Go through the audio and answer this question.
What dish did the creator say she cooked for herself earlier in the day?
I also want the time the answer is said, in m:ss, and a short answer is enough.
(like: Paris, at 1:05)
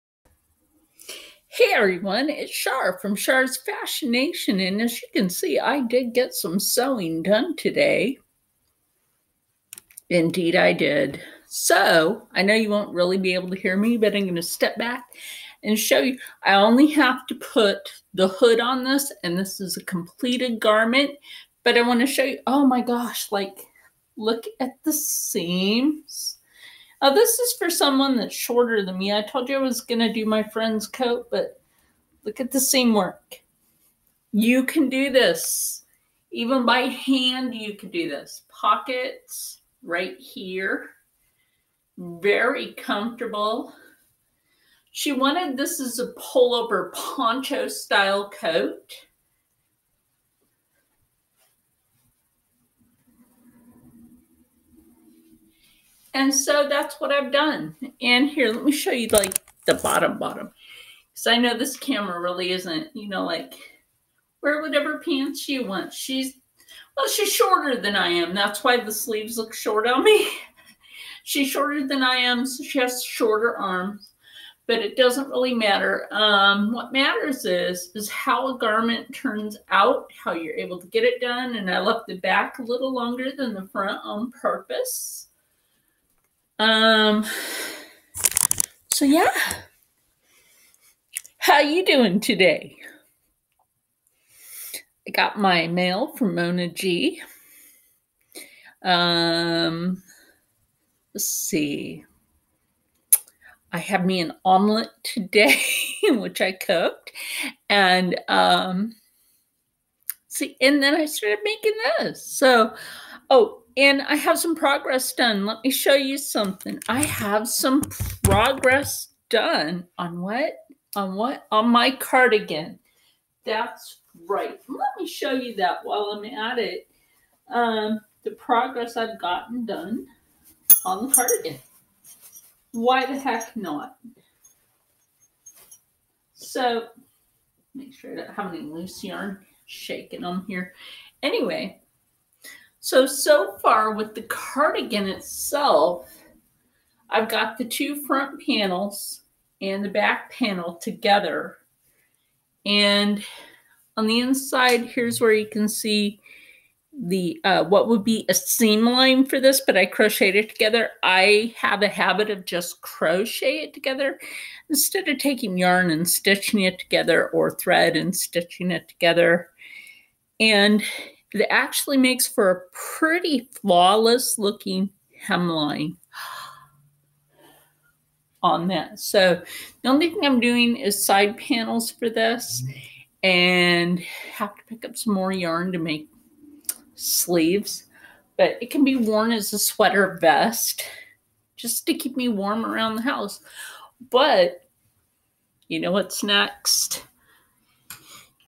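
Omelet, at 1:44.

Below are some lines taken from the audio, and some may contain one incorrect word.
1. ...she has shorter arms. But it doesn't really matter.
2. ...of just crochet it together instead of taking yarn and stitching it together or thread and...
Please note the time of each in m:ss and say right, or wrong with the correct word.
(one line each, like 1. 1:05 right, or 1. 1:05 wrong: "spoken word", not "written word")
1. 1:12 right
2. 2:42 right.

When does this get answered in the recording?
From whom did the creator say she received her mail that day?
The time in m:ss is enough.
1:36.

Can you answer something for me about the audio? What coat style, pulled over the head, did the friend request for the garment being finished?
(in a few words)
Pullover poncho style.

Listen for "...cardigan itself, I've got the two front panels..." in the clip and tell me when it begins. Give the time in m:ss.
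2:24.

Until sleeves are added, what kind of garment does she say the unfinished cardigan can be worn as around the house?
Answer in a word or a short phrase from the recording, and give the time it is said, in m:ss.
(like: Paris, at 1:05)
Sweater vest, at 3:09.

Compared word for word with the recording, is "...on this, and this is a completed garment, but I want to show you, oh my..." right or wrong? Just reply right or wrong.
right.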